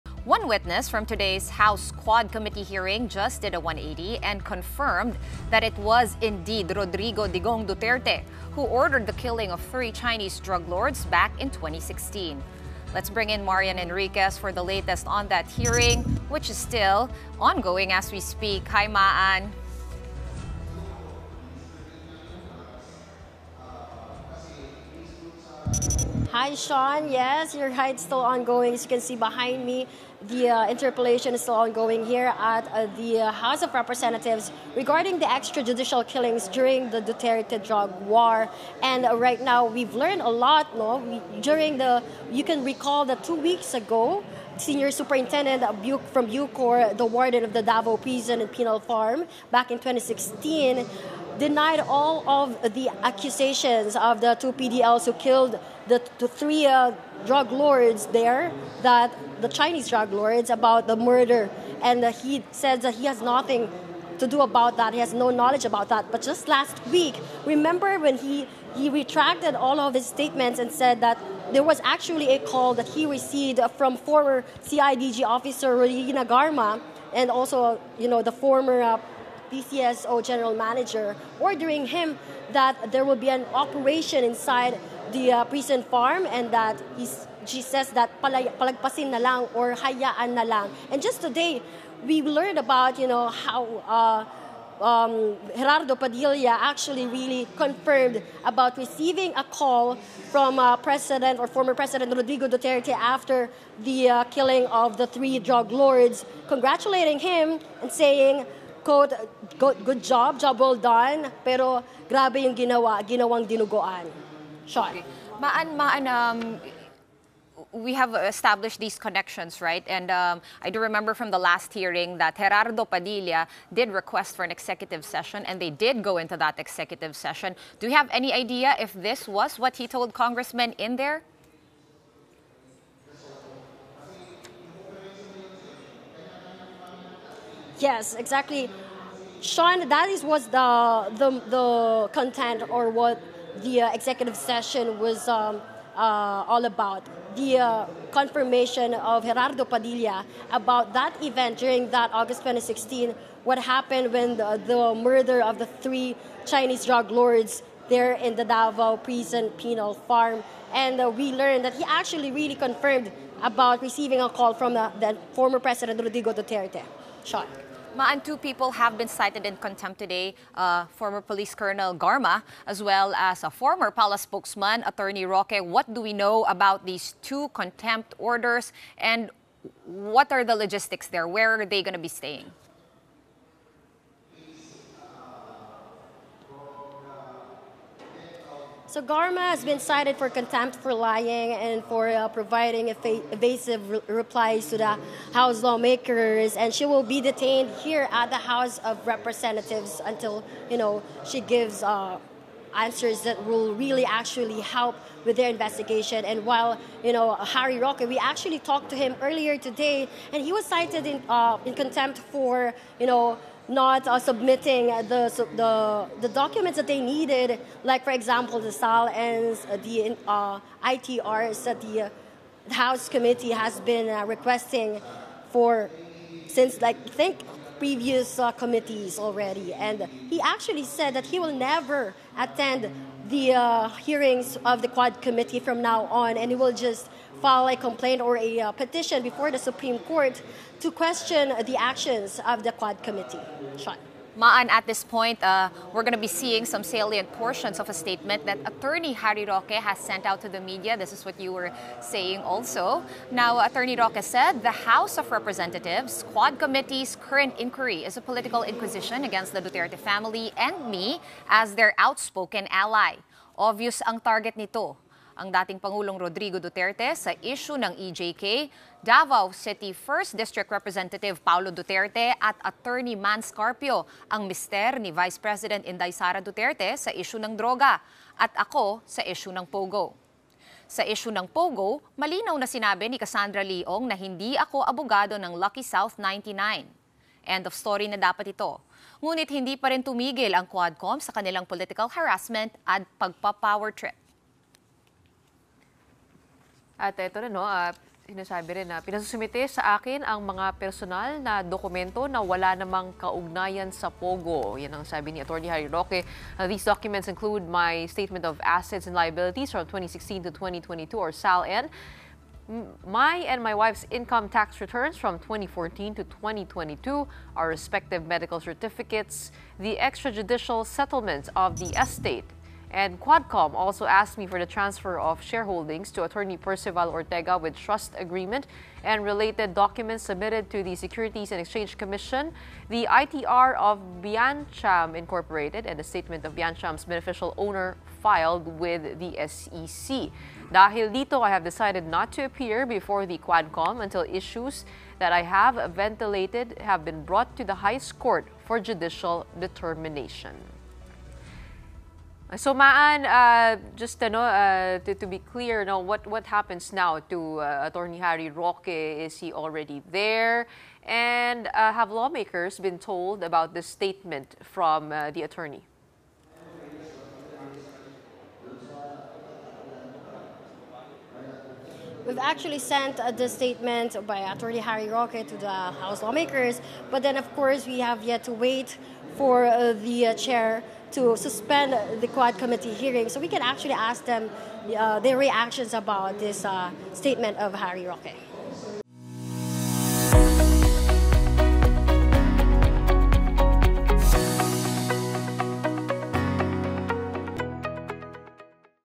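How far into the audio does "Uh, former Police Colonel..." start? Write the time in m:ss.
2:50.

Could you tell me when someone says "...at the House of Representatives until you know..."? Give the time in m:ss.
3:18.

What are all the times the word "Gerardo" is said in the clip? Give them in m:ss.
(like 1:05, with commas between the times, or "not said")
1:35, 2:02, 2:29.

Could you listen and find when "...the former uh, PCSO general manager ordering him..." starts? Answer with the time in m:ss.
1:18.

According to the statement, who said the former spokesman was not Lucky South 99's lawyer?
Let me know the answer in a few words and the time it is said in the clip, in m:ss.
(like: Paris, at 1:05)
Cassandra Leong, at 4:43.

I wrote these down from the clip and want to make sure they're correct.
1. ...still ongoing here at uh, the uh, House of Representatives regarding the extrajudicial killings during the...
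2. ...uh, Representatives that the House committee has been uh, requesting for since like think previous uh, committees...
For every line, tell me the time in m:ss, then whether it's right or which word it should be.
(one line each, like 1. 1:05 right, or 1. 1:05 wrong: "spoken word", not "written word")
1. 0:31 right
2. 3:40 wrong: "ITRs", not "Representatives".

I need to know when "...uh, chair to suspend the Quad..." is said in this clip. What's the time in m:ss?
6:20.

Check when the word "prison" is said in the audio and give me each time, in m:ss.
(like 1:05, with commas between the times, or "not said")
0:47, 1:25, 2:38.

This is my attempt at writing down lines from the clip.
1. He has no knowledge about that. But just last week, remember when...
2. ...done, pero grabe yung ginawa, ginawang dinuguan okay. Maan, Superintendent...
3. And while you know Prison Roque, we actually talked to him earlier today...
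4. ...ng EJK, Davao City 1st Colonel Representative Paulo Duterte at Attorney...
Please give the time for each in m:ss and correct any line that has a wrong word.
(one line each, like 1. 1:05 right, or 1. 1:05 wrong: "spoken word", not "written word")
1. 1:04 right
2. 1:50 wrong: "Maan", not "Superintendent"
3. 3:26 wrong: "Harry", not "Prison"
4. 4:27 wrong: "District", not "Colonel".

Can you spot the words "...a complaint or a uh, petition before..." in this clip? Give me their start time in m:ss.
3:57.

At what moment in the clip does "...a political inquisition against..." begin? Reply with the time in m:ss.
4:18.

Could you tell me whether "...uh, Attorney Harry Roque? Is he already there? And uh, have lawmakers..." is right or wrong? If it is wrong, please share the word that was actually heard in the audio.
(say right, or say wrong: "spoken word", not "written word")
right.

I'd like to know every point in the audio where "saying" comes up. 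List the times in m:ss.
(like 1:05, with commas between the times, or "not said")
1:47, 4:11.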